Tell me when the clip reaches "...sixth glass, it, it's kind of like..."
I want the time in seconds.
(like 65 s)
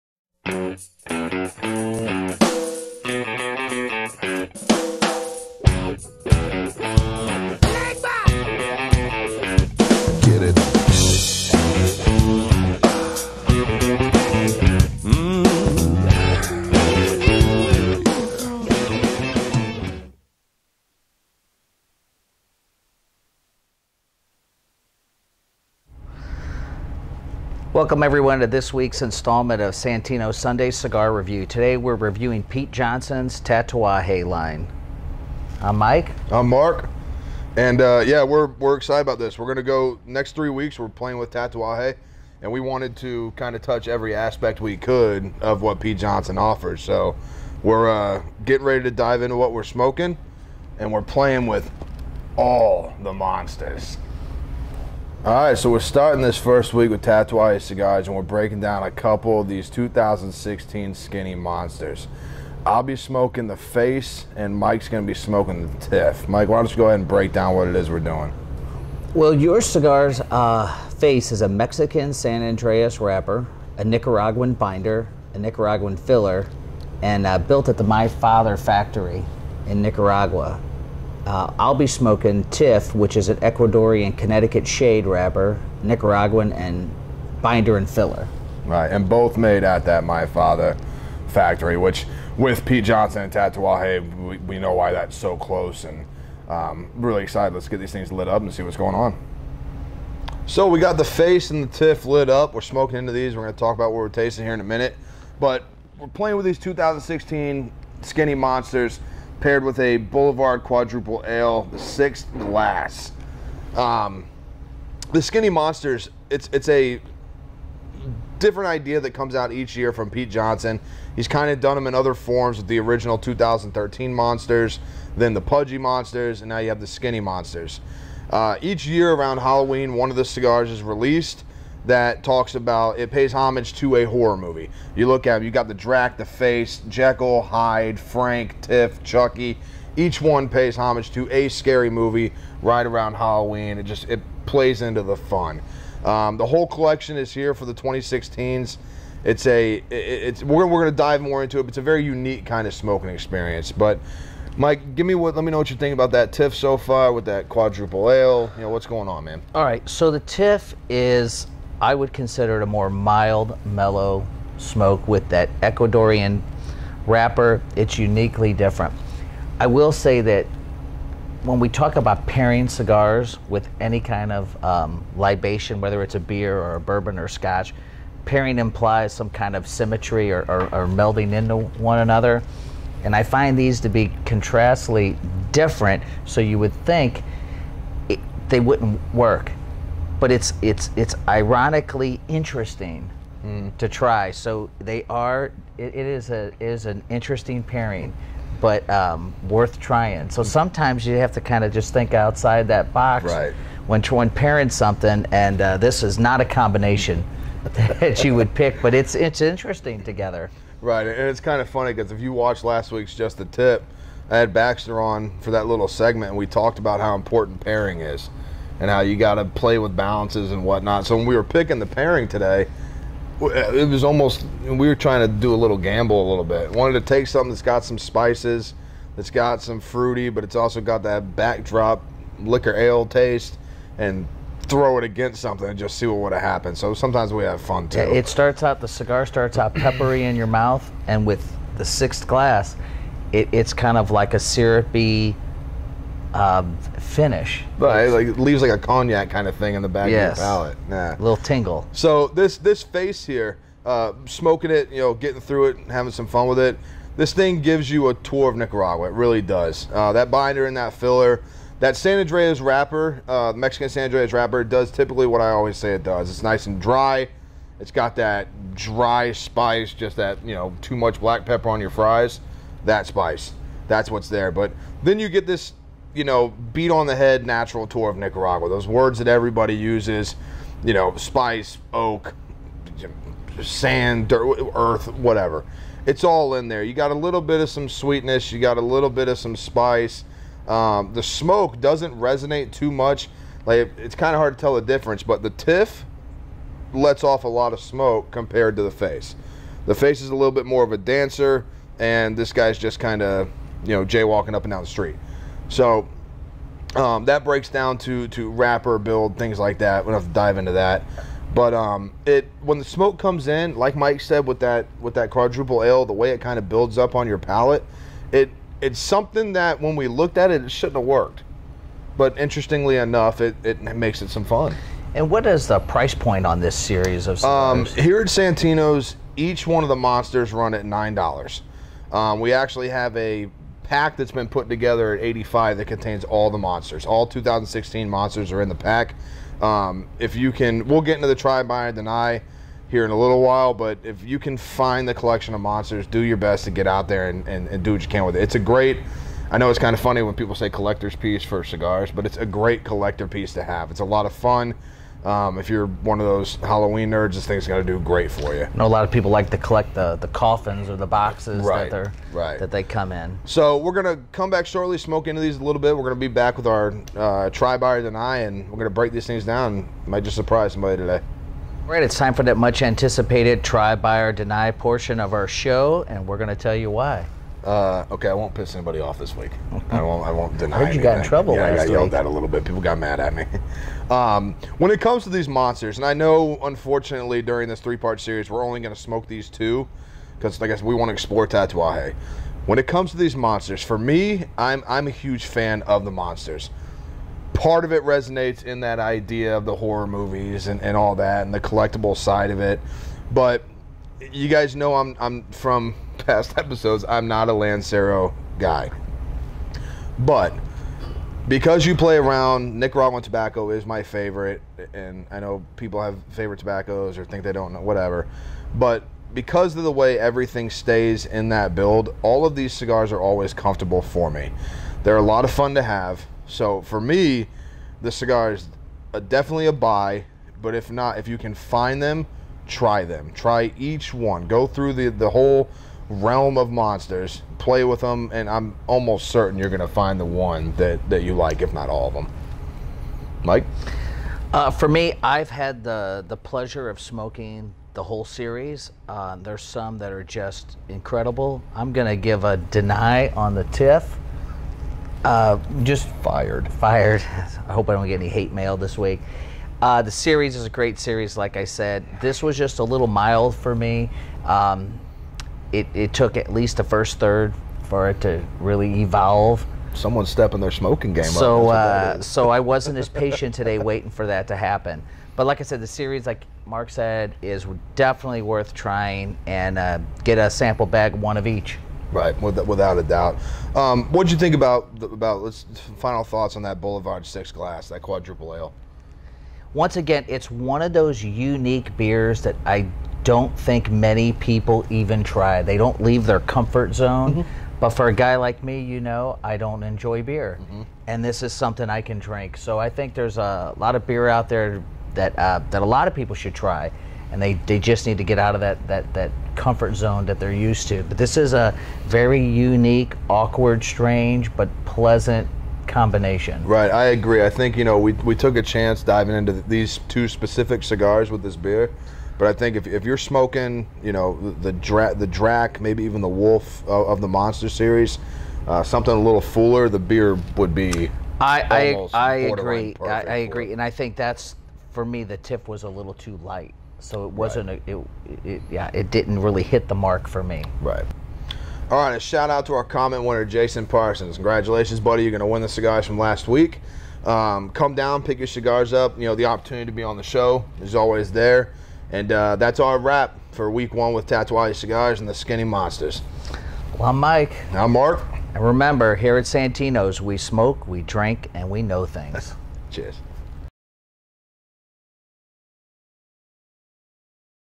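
241 s.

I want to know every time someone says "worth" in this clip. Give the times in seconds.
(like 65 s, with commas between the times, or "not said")
199 s, 478 s.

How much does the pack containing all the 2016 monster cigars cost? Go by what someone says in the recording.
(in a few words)
85.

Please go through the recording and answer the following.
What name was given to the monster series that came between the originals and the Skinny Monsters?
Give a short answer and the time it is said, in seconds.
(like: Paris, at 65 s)
Pudgy Monsters, at 125 s.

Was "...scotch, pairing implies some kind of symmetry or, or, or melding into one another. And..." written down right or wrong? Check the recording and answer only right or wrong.
right.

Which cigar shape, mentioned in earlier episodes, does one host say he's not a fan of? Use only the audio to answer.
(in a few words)
Lancero.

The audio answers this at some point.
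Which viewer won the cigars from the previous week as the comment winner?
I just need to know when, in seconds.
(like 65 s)
543 s.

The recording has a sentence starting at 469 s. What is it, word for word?
Someone's stepping their smoking game so, up.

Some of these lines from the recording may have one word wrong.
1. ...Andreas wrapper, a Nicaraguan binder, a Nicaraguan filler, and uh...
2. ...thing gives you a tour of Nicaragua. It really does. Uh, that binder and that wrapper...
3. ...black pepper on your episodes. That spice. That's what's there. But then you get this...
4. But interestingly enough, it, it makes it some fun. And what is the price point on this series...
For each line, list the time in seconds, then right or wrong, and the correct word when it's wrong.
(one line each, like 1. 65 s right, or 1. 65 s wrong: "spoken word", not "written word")
1. 72 s right
2. 257 s wrong: "filler", not "wrapper"
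3. 271 s wrong: "fries", not "episodes"
4. 322 s right.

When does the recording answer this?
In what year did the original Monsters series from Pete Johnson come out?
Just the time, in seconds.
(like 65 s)
123 s.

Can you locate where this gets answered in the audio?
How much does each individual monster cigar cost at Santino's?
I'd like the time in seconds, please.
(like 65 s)
330 s.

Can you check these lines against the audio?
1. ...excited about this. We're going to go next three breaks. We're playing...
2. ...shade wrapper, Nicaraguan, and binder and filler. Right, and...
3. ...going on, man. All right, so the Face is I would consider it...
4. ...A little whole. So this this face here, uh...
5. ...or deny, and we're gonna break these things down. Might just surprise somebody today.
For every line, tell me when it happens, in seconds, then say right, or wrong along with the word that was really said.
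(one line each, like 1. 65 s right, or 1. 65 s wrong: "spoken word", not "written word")
1. 38 s wrong: "weeks", not "breaks"
2. 84 s right
3. 158 s wrong: "TIFF", not "Face"
4. 251 s wrong: "tingle", not "whole"
5. 367 s right.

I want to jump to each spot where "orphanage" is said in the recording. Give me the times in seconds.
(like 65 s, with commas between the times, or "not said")
not said.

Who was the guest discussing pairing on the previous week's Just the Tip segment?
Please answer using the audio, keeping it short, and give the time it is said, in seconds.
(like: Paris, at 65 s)
Baxter, at 214 s.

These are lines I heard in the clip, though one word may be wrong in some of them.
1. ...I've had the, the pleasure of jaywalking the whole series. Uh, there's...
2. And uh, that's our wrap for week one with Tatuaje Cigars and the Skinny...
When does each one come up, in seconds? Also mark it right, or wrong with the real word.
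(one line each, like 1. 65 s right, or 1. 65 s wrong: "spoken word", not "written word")
1. 445 s wrong: "smoking", not "jaywalking"
2. 552 s right.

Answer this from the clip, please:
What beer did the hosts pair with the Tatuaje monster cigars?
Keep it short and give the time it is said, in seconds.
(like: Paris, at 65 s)
Boulevard Quadruple Ale, at 109 s.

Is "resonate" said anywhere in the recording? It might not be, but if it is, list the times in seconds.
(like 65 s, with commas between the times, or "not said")
292 s, 398 s.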